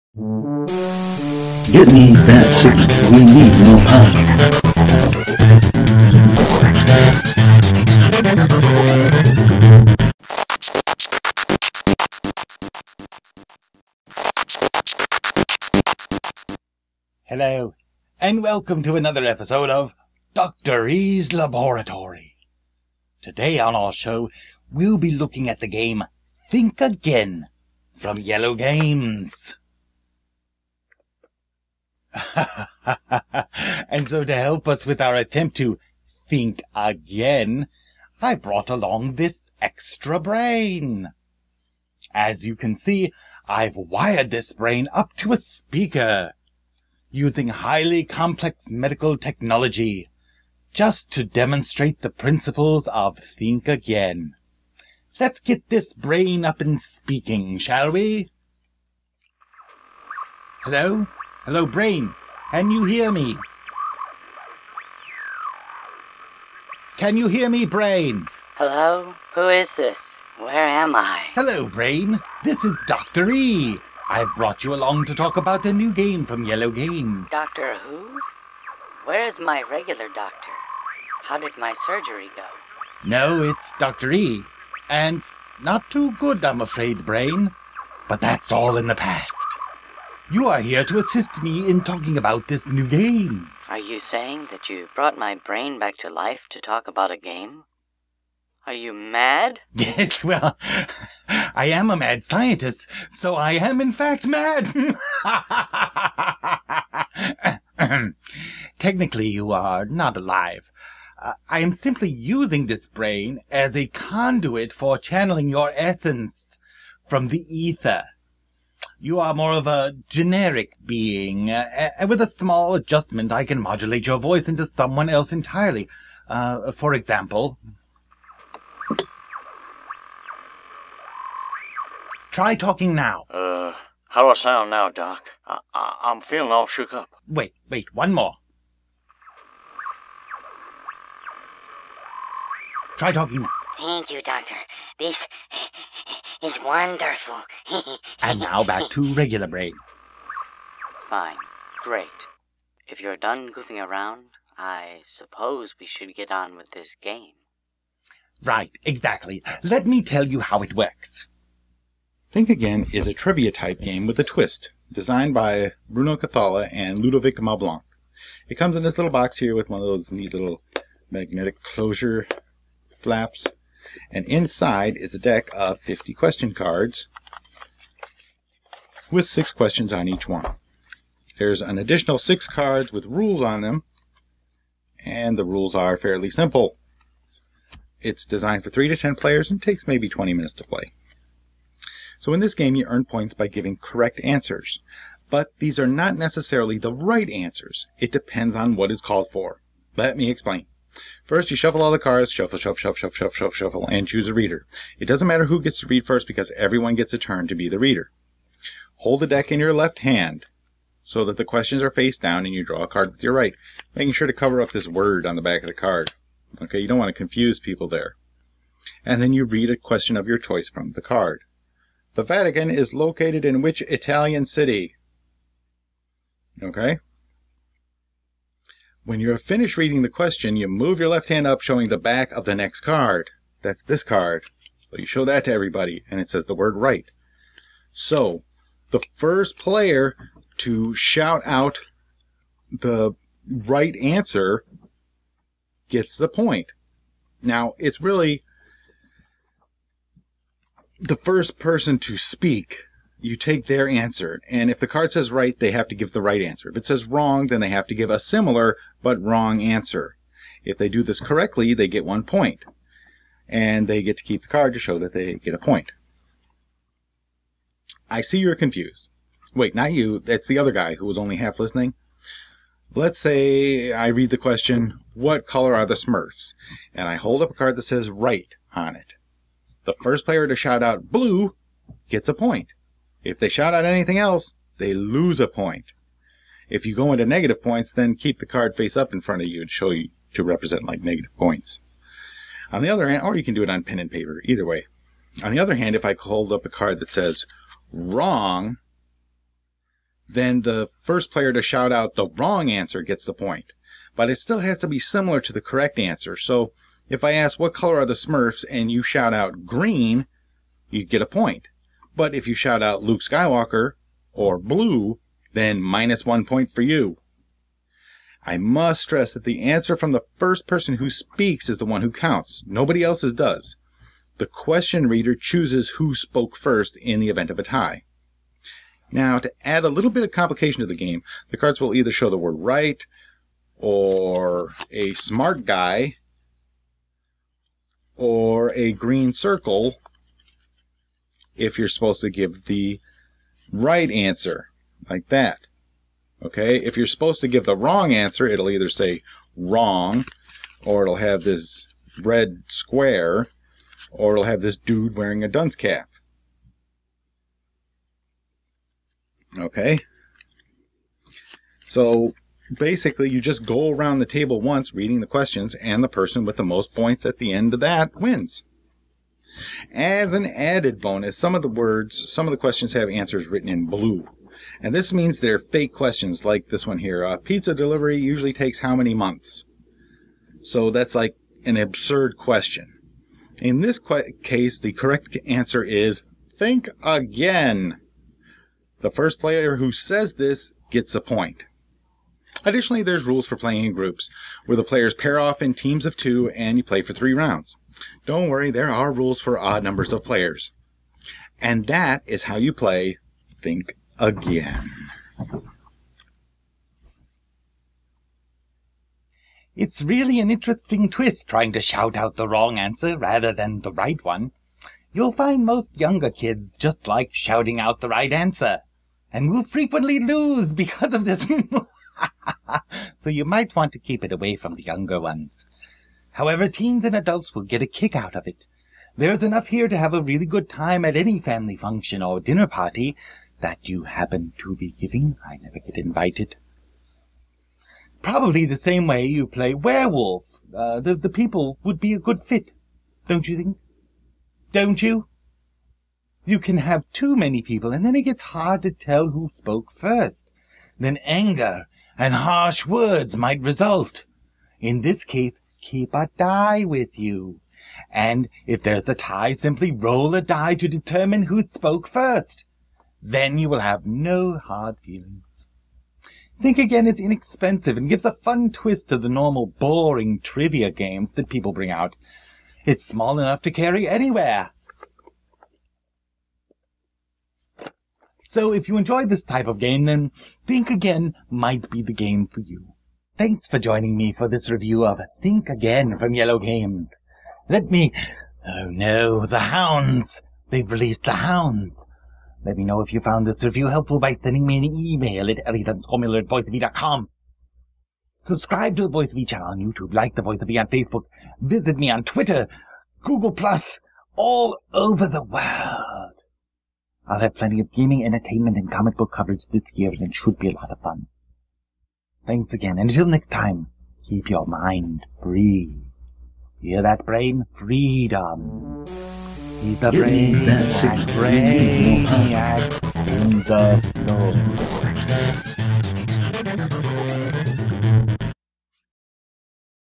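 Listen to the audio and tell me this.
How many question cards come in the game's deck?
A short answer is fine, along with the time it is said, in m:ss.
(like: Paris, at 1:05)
50, at 2:55.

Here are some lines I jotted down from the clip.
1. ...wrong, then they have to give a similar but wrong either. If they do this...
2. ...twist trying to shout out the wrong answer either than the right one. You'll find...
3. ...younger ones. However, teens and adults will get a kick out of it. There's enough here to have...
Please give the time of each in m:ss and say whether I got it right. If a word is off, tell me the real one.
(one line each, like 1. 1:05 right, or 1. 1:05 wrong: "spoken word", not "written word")
1. 4:17 wrong: "answer", not "either"
2. 6:51 wrong: "rather", not "either"
3. 7:04 right.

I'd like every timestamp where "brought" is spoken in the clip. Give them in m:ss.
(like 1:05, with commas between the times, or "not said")
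0:38, 1:14, 1:34.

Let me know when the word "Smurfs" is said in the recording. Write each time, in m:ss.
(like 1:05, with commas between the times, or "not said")
4:35, 5:08.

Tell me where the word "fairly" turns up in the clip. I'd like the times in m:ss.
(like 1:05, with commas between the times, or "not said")
3:05.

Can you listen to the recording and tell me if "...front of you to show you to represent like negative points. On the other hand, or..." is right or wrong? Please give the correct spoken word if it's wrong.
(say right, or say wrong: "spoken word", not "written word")
right.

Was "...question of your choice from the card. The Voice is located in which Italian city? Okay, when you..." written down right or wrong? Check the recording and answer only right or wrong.
wrong.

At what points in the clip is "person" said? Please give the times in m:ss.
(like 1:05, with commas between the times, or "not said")
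4:11, 5:20, 6:06.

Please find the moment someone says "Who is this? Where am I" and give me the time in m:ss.
1:09.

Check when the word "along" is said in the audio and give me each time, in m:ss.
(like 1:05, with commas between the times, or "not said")
0:38, 1:14.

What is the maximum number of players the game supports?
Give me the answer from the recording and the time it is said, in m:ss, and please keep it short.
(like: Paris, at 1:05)
10, at 3:08.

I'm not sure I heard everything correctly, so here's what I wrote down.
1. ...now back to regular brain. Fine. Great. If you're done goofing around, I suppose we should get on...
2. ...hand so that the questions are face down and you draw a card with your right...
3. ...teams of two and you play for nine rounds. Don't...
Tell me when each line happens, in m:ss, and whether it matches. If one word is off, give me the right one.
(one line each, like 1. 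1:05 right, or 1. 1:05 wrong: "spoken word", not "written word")
1. 2:28 right
2. 3:29 right
3. 6:35 wrong: "three", not "nine".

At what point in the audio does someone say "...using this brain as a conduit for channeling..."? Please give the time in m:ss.
1:52.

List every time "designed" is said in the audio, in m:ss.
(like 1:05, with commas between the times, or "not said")
2:44, 3:08.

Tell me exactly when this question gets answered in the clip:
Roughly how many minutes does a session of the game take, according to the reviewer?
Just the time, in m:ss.
3:10.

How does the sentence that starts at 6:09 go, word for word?
As an added bonus, some of the words, some of the questions have answers written in blue.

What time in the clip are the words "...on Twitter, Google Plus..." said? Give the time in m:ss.
8:22.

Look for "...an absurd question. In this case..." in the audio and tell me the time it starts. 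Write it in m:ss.
6:21.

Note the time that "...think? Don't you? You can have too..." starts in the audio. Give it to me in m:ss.
7:23.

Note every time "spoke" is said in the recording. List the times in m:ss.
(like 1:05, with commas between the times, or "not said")
5:26, 7:29, 7:41.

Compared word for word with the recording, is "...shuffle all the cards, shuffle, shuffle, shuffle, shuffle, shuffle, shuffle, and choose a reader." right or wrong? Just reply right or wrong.
right.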